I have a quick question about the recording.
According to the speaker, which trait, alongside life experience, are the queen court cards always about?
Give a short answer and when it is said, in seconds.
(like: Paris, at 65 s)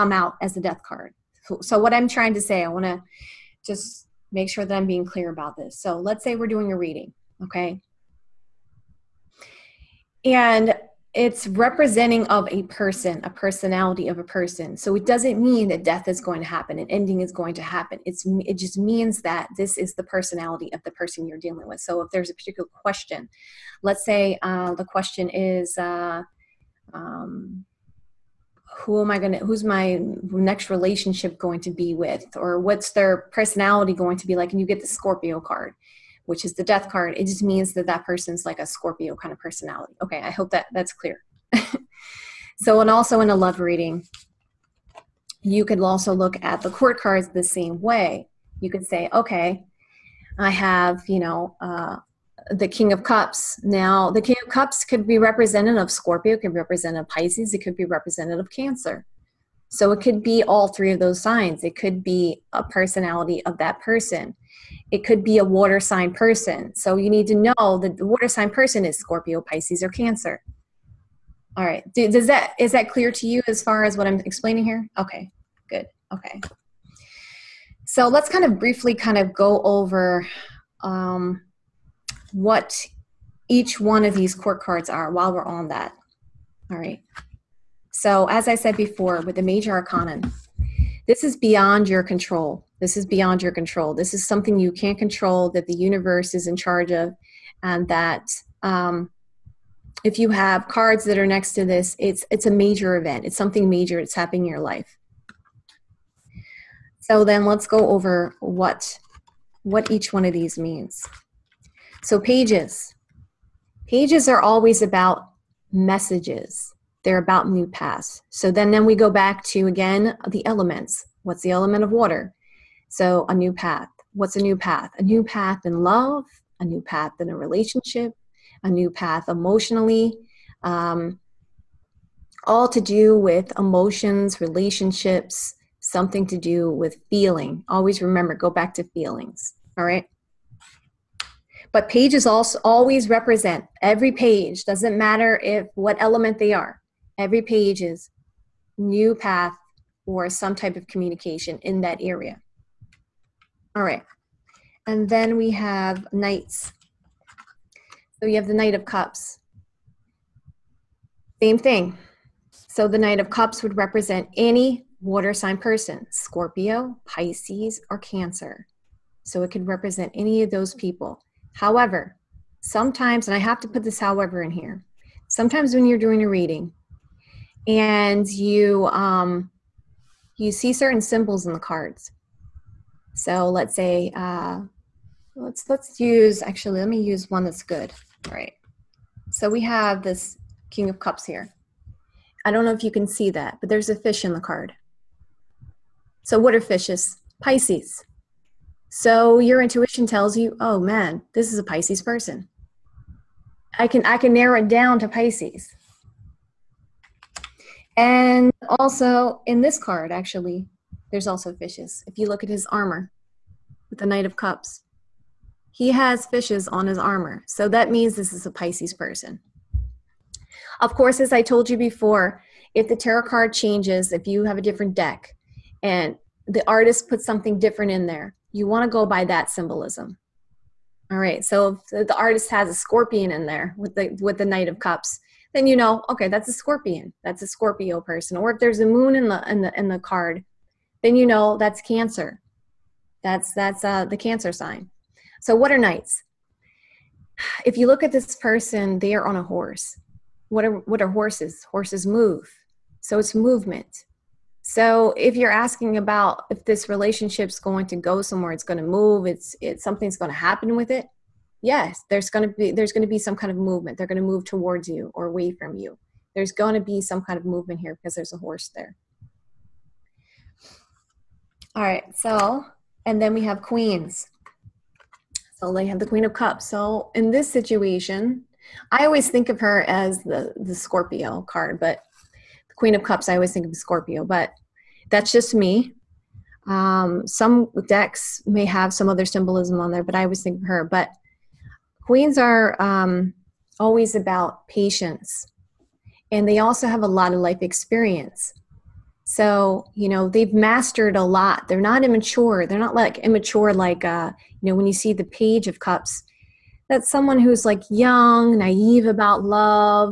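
patience, at 294 s.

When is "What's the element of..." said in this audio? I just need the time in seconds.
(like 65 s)
121 s.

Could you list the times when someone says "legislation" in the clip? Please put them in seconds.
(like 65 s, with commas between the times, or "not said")
not said.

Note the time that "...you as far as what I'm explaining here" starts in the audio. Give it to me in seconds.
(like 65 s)
73 s.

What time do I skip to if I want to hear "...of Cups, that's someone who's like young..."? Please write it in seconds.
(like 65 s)
305 s.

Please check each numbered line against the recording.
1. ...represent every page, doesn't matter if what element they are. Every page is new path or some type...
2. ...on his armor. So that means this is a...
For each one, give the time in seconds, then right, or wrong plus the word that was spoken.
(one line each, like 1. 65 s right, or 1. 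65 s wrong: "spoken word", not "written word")
1. 143 s right
2. 216 s right.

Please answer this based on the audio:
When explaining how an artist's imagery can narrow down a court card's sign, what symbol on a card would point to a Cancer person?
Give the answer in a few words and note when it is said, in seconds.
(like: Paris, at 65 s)
a moon, at 238 s.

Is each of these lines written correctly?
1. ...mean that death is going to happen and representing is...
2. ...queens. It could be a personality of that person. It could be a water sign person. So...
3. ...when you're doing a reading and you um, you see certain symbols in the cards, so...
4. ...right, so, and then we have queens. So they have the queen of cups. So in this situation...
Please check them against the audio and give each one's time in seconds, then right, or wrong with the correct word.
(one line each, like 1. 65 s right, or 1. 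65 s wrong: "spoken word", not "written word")
1. 15 s wrong: "ending", not "representing"
2. 61 s wrong: "signs", not "queens"
3. 175 s right
4. 271 s right.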